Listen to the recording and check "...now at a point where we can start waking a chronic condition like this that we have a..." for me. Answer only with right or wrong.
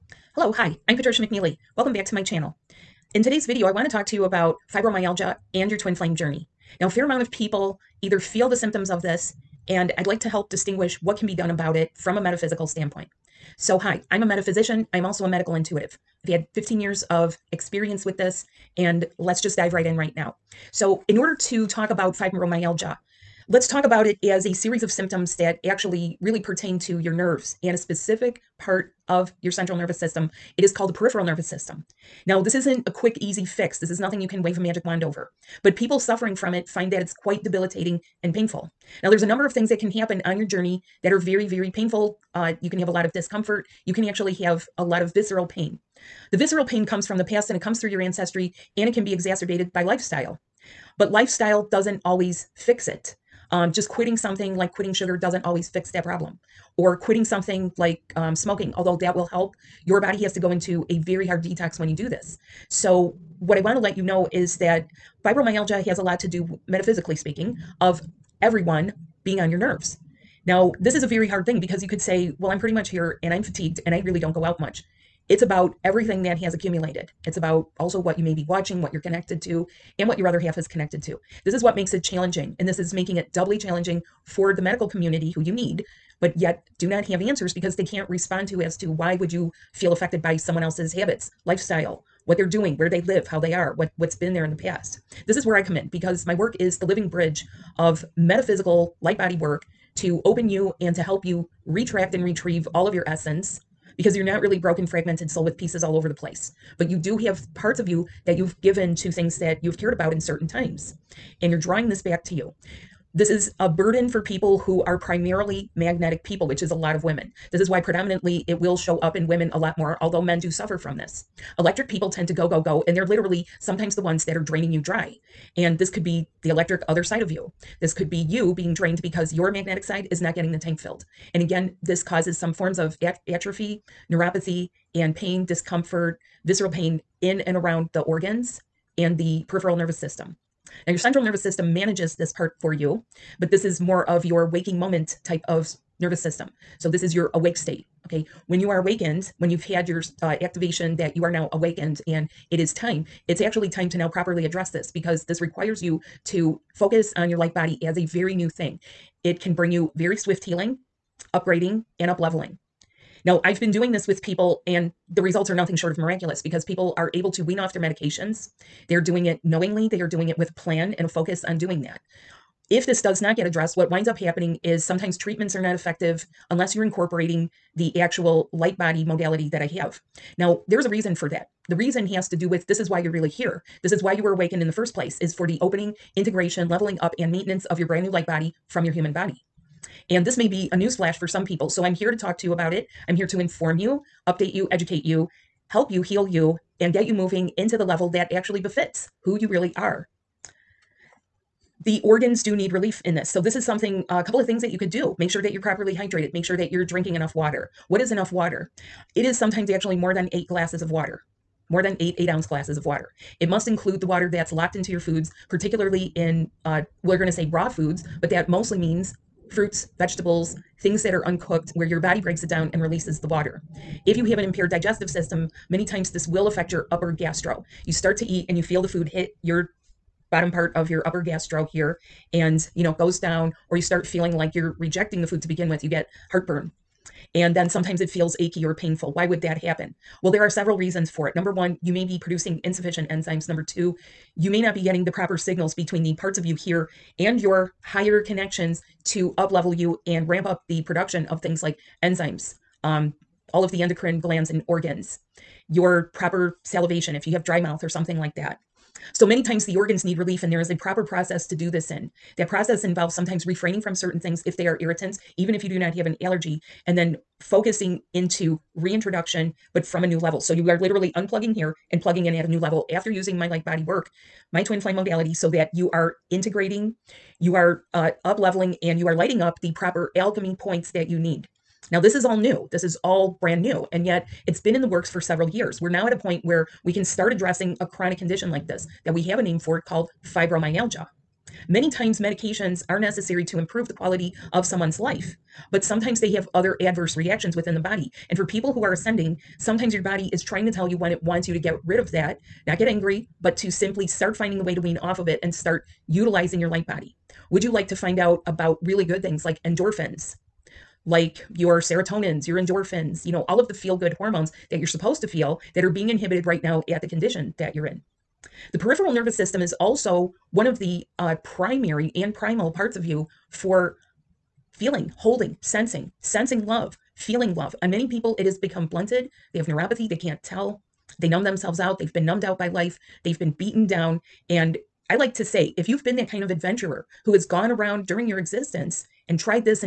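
wrong.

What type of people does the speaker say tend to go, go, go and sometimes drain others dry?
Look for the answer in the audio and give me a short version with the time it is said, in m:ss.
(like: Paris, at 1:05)
Electric people, at 2:01.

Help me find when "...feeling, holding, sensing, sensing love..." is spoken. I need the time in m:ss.
5:24.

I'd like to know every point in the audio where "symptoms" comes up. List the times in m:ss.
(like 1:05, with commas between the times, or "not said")
0:08, 0:24.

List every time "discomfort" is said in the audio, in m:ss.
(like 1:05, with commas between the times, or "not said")
0:43, 2:15.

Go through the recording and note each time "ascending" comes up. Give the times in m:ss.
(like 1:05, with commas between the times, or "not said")
4:58.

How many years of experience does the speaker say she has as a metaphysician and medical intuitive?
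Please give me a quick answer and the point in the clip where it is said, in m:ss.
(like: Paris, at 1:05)
15, at 0:16.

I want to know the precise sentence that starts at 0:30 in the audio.
It is called the peripheral nervous system.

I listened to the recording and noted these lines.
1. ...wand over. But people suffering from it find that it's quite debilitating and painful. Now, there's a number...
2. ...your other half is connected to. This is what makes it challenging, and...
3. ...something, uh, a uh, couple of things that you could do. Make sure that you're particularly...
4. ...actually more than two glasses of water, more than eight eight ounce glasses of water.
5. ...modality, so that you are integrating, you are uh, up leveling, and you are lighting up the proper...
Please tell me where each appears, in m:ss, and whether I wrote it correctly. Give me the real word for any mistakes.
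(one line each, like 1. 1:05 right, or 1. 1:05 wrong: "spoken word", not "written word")
1. 0:34 right
2. 1:20 right
3. 3:23 wrong: "properly", not "particularly"
4. 3:29 wrong: "eight", not "two"
5. 4:34 right.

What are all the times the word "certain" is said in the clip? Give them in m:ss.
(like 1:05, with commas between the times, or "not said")
1:50, 4:23.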